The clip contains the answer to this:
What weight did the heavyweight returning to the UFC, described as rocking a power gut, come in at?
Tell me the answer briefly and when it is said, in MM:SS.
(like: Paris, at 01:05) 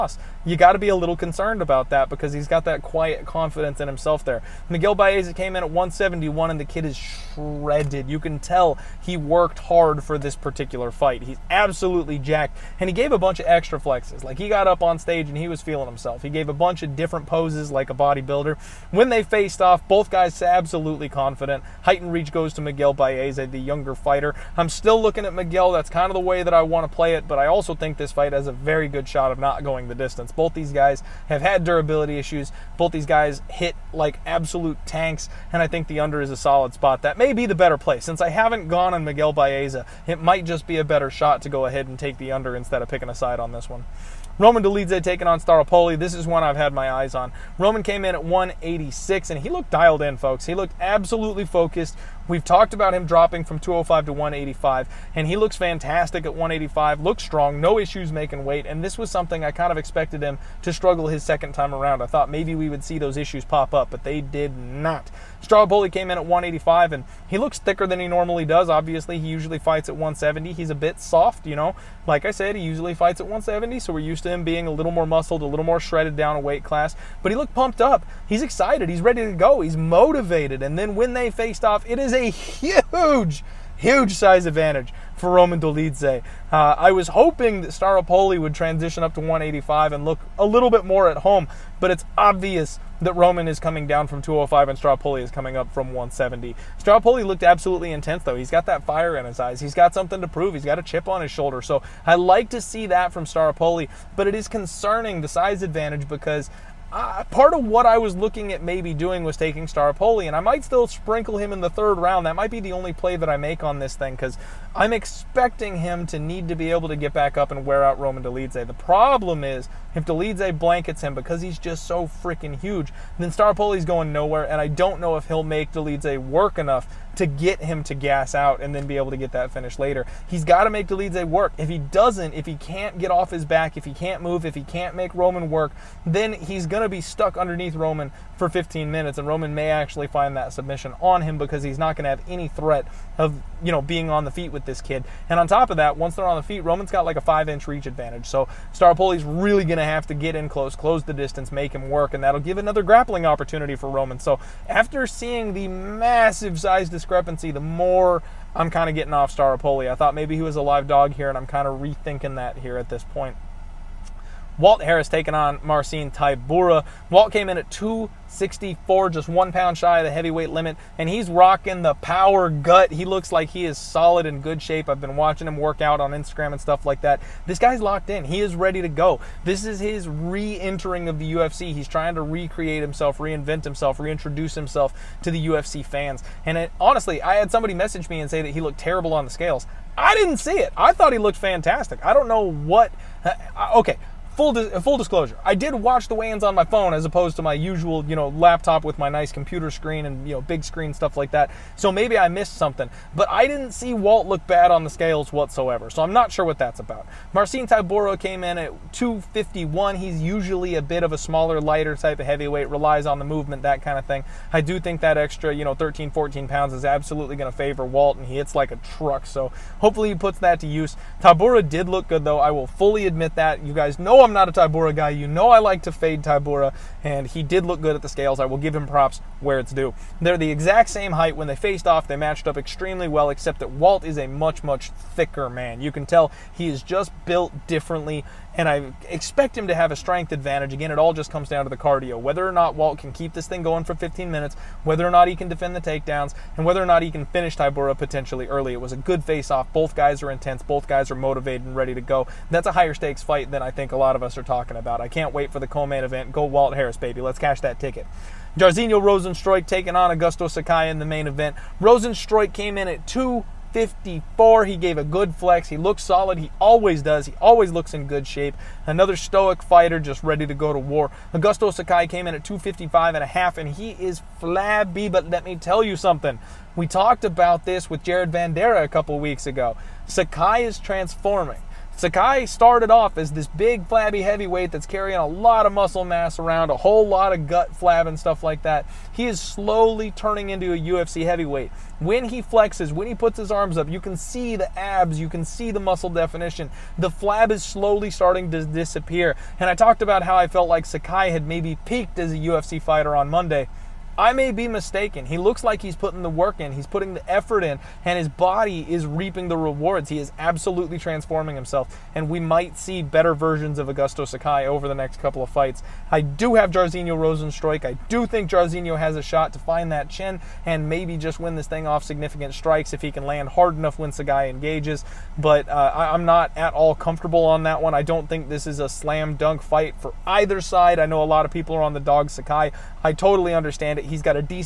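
264, at 02:47.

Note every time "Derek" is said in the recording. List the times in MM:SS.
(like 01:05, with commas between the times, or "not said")
not said.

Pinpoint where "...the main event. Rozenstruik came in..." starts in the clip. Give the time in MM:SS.
04:20.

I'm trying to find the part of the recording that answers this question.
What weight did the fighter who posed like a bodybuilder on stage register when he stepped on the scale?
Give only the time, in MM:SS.
00:05.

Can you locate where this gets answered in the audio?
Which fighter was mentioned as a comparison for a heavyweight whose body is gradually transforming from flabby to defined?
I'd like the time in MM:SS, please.
04:38.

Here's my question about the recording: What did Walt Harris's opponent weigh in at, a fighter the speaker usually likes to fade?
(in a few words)
251.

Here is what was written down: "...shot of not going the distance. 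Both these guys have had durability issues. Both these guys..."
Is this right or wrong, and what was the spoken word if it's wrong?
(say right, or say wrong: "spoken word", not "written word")
right.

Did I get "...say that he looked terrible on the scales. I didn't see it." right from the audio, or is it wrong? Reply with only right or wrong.
right.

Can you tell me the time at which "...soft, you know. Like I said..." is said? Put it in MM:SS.
01:10.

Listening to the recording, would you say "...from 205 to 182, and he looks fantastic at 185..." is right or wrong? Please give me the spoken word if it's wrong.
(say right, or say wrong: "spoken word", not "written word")
wrong: "185", not "182".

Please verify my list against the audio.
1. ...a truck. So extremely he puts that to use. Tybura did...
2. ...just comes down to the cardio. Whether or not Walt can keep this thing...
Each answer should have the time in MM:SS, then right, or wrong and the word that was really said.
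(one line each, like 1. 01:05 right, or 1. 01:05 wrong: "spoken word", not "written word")
1. 03:38 wrong: "hopefully", not "extremely"
2. 04:01 right.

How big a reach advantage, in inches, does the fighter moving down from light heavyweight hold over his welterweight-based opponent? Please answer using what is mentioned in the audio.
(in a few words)
5 inches.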